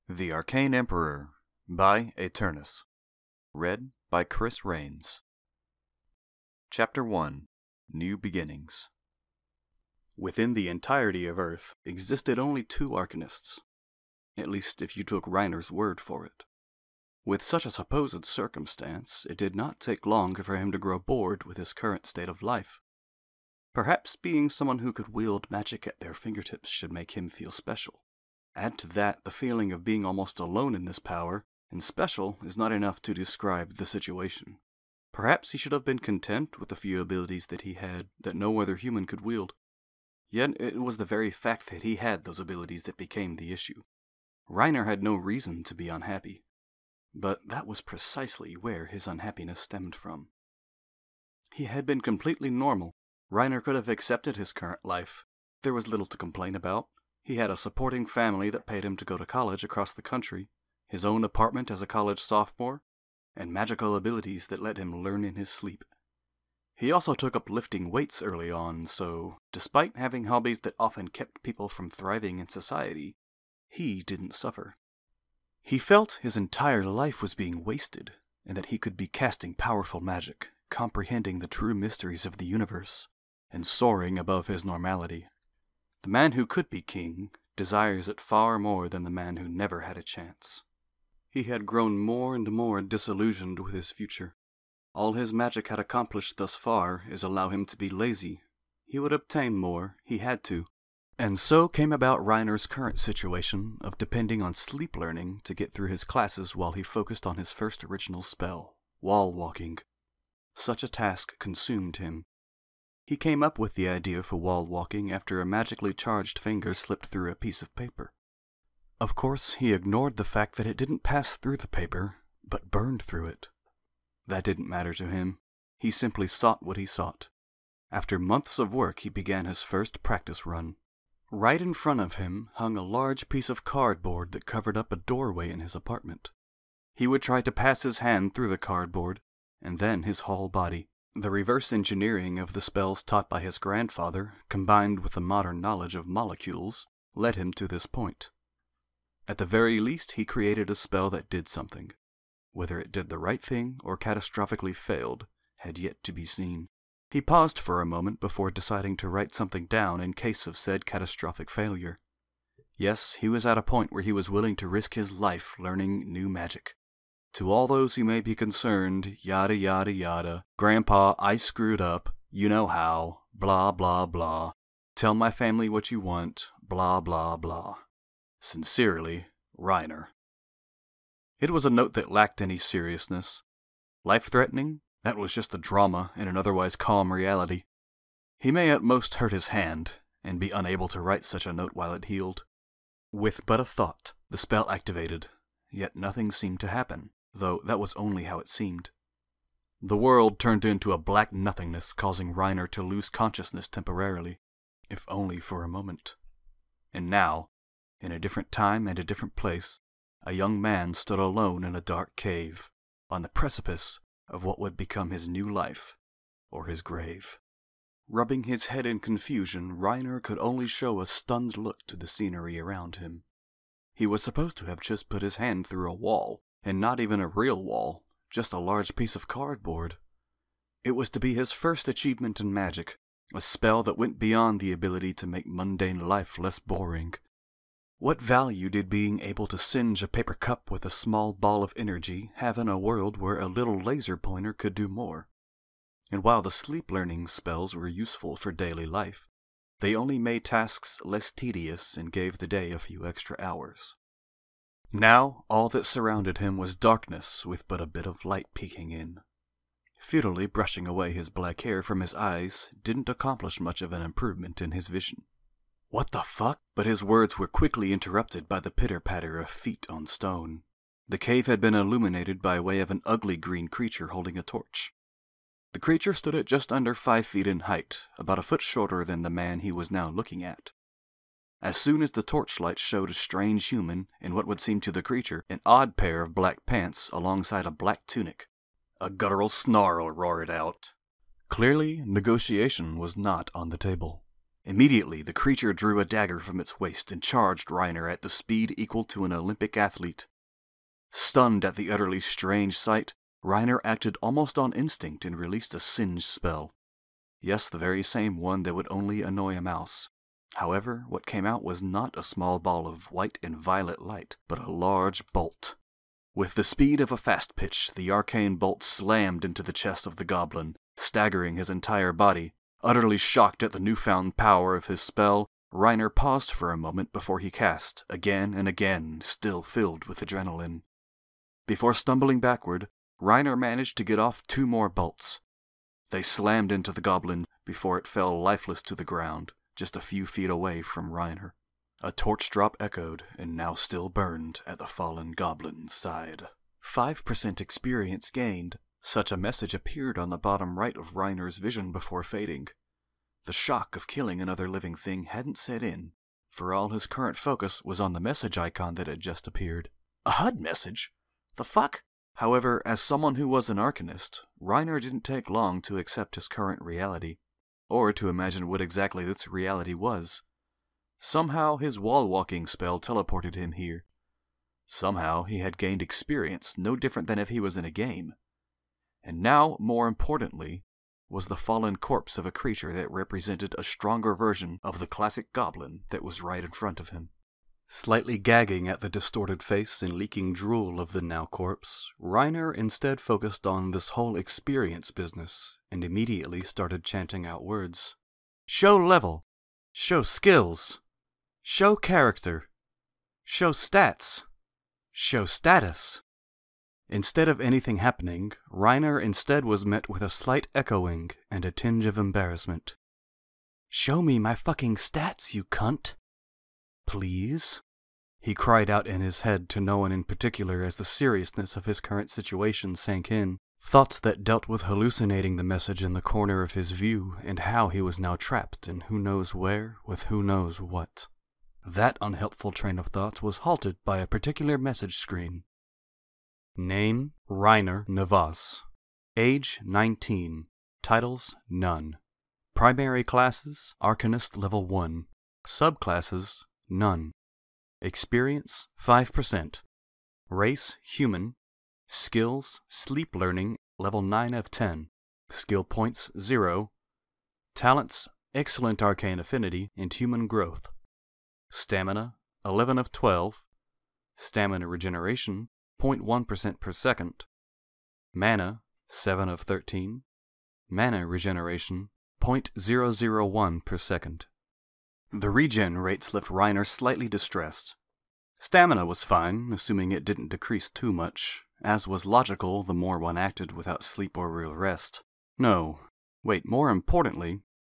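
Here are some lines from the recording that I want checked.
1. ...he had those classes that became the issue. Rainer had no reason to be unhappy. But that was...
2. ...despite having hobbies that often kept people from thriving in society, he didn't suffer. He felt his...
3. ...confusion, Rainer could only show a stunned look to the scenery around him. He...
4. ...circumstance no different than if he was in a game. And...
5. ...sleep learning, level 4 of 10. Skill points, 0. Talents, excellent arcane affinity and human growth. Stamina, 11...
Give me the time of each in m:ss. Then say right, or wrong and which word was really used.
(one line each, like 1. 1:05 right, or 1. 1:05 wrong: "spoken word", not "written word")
1. 0:41 wrong: "abilities", not "classes"
2. 1:09 right
3. 3:38 right
4. 6:16 wrong: "experience", not "circumstance"
5. 7:32 wrong: "9", not "4".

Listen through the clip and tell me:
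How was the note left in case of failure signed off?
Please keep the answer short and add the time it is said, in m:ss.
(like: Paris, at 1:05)
Sincerely, Rainer, at 2:58.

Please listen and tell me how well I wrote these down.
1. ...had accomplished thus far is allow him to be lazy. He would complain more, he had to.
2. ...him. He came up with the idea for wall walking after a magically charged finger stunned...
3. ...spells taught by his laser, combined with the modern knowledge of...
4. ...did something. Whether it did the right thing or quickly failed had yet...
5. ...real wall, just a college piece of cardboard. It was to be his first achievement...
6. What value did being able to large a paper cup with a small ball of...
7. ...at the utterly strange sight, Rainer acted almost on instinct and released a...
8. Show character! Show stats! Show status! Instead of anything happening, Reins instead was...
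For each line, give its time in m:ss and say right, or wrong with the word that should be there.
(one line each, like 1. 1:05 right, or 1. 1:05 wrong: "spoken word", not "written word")
1. 1:35 wrong: "obtain", not "complain"
2. 1:51 wrong: "slipped", not "stunned"
3. 2:22 wrong: "grandfather", not "laser"
4. 2:31 wrong: "catastrophically", not "quickly"
5. 3:47 wrong: "large", not "college"
6. 3:57 wrong: "singe", not "large"
7. 5:01 right
8. 6:41 wrong: "Rainer", not "Reins".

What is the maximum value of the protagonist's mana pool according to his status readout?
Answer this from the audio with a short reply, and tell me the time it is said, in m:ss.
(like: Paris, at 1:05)
13, at 7:49.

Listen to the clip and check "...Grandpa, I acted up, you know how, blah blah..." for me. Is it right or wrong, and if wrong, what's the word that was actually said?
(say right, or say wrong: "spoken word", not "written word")
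wrong: "screwed", not "acted".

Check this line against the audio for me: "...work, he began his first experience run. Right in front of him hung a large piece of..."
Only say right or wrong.
wrong.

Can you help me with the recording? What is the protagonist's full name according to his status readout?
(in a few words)
Rainer Navas.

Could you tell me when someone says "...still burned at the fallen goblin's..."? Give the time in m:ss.
5:43.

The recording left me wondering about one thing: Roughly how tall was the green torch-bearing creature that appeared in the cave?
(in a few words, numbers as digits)
Just under five feet.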